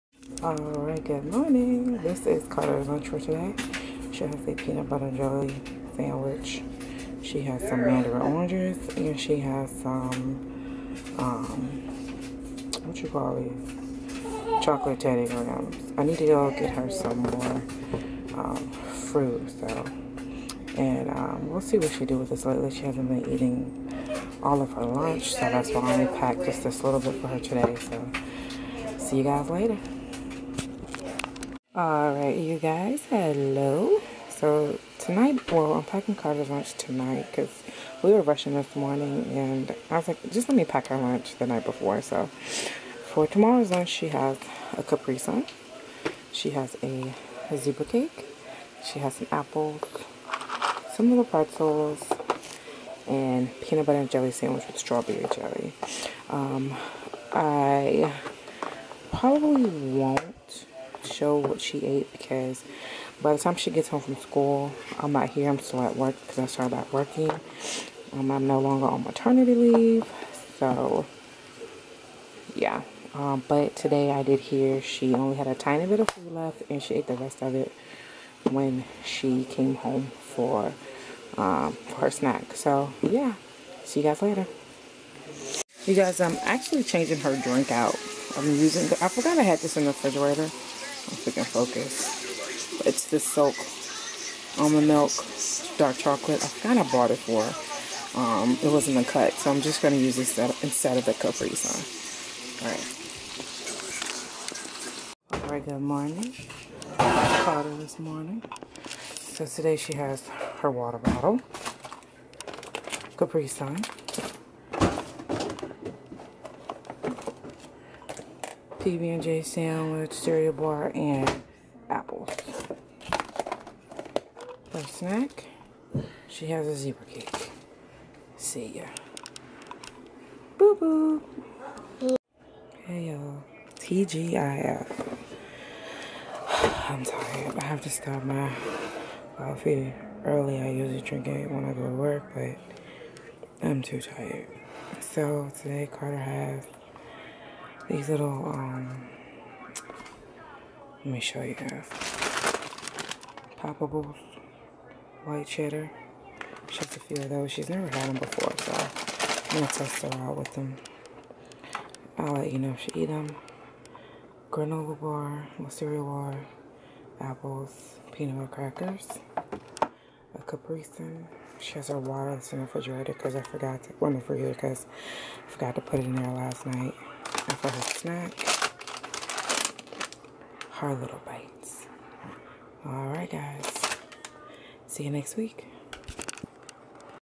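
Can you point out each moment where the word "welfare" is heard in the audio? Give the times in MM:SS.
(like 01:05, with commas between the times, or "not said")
not said.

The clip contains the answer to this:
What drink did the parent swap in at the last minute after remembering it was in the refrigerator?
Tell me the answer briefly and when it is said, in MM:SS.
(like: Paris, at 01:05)
Silk almond milk, dark chocolate, at 01:33.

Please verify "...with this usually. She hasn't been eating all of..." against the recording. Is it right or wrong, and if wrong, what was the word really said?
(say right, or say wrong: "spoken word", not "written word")
wrong: "lately", not "usually".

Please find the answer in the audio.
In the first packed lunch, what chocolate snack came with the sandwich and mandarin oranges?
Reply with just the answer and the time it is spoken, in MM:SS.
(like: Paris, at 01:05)
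Chocolate Teddy Grahams, at 00:14.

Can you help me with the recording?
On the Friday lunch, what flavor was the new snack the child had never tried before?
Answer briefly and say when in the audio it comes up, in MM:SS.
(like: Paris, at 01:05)
White cheddar, at 02:35.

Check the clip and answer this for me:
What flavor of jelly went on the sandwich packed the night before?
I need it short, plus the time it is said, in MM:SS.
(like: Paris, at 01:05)
Strawberry, at 00:54.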